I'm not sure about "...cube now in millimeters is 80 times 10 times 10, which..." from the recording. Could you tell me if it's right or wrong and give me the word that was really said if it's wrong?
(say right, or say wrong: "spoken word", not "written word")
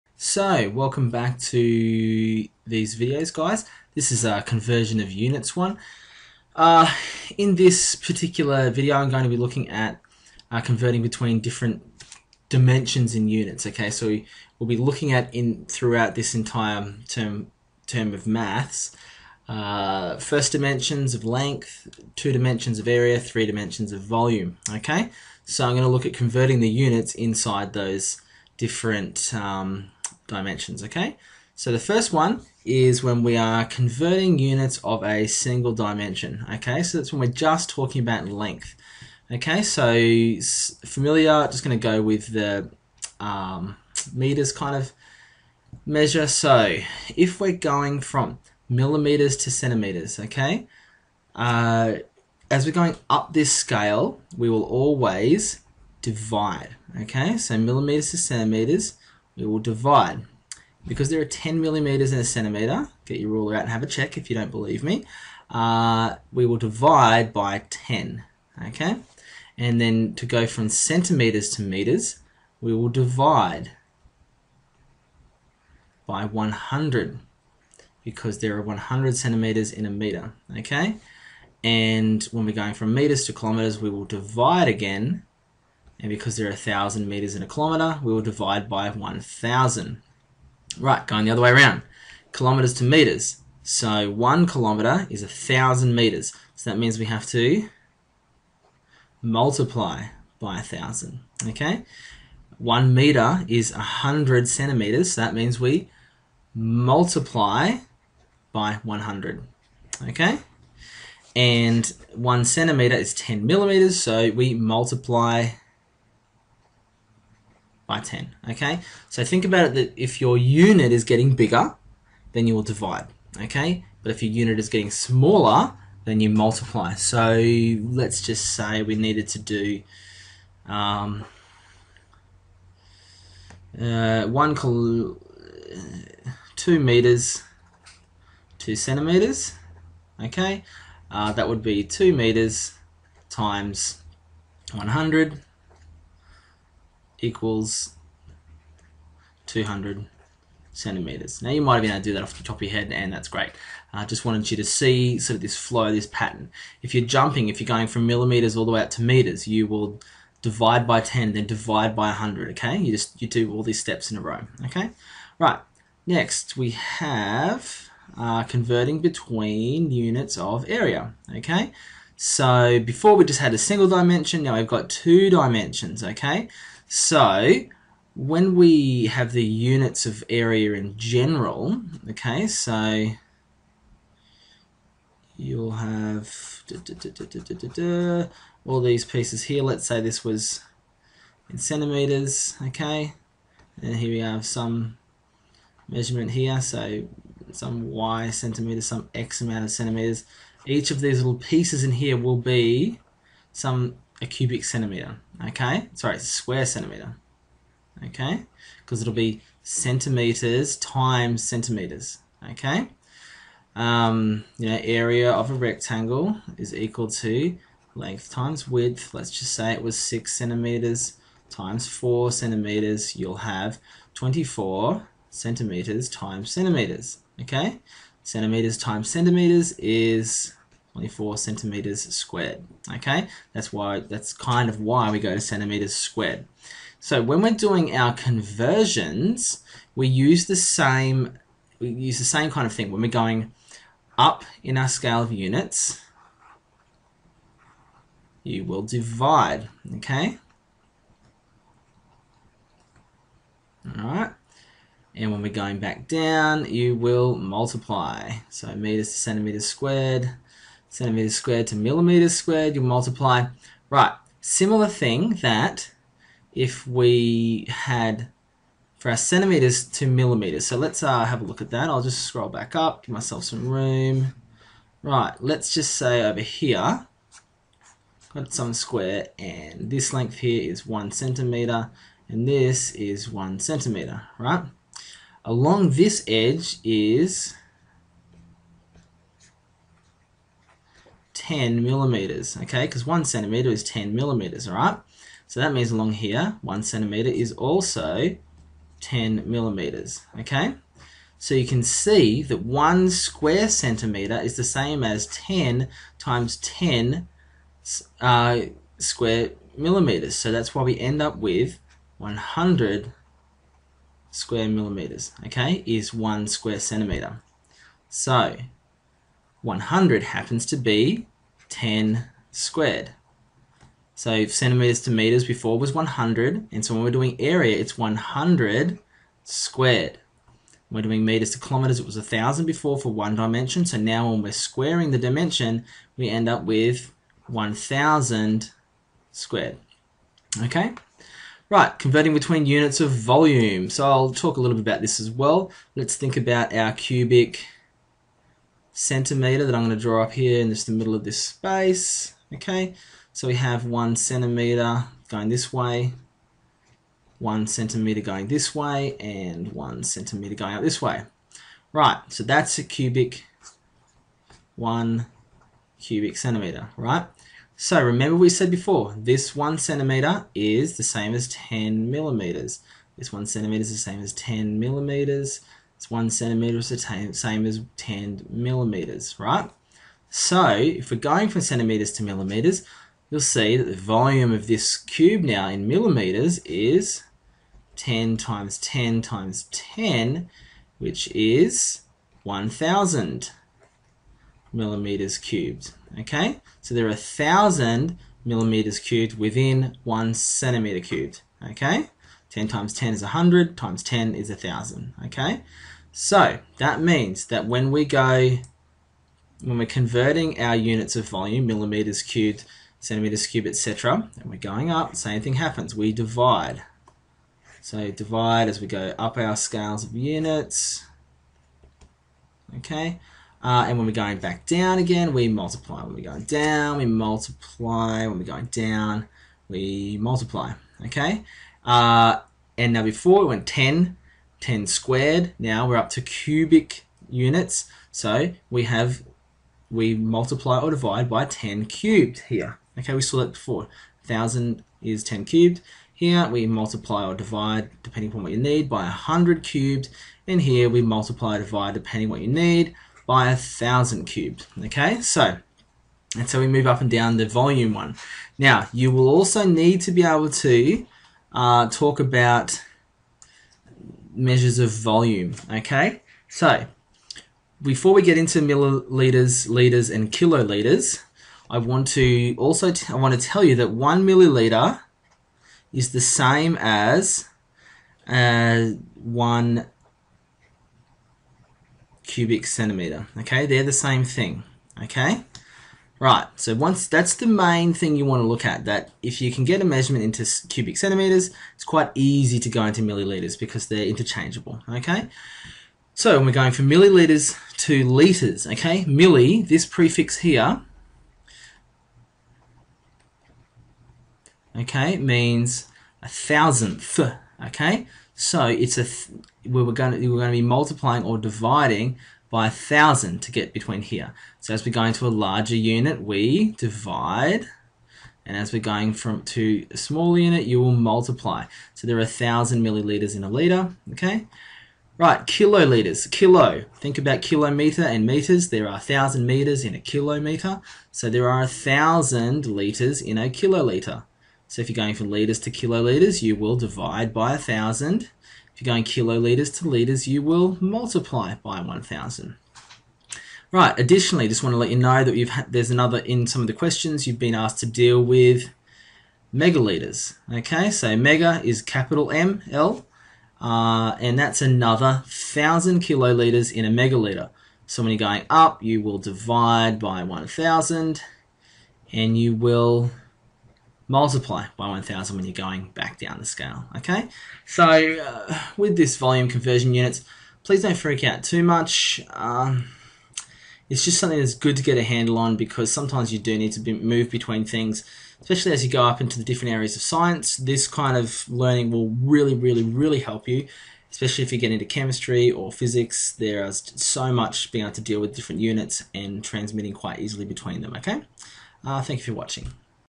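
wrong: "10", not "80".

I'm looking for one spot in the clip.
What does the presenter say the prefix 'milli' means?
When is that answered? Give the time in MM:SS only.
08:26.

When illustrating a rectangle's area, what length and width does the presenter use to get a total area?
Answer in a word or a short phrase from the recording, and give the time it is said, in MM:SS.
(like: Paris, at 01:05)
6 cm by 4 cm, at 03:39.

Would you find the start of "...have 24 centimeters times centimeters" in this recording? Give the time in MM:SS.
03:43.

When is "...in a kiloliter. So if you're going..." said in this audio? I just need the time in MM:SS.
08:53.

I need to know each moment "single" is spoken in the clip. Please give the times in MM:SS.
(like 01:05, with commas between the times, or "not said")
00:35, 02:53.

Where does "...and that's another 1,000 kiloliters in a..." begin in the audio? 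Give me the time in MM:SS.
09:14.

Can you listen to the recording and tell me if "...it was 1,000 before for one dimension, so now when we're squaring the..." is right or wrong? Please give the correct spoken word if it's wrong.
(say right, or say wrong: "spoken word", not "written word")
right.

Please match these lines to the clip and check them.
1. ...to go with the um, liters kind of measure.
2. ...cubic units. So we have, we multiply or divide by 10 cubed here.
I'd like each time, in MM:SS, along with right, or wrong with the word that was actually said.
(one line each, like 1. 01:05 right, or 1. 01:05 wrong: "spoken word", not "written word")
1. 00:41 wrong: "meters", not "liters"
2. 07:16 right.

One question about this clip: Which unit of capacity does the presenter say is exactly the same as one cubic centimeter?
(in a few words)
One milliliter.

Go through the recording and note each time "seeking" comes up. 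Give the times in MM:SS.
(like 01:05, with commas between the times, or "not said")
not said.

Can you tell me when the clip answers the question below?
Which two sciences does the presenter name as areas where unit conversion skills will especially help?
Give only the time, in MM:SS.
09:44.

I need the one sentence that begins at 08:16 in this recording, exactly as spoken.
So we're going from millilitres to litres, okay?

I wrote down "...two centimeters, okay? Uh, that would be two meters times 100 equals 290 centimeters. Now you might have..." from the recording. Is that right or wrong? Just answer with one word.
wrong.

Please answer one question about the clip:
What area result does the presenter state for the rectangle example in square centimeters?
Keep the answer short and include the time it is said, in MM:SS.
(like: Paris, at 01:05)
24 square centimeters, at 03:50.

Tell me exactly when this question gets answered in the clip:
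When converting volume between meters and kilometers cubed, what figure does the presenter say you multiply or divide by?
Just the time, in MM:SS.
07:33.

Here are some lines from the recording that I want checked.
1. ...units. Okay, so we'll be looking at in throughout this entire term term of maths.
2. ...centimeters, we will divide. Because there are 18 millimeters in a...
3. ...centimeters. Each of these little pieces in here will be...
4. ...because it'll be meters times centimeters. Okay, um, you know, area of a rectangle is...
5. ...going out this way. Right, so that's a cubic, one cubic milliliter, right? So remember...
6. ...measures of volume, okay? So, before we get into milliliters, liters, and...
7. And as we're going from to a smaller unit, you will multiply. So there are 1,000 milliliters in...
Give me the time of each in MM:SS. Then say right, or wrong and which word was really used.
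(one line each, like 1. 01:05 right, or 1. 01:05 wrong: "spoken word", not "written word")
1. 00:13 right
2. 00:58 wrong: "10", not "18"
3. 03:19 right
4. 03:28 wrong: "centimeters", not "meters"
5. 06:00 wrong: "centimeter", not "milliliter"
6. 07:44 right
7. 08:38 right.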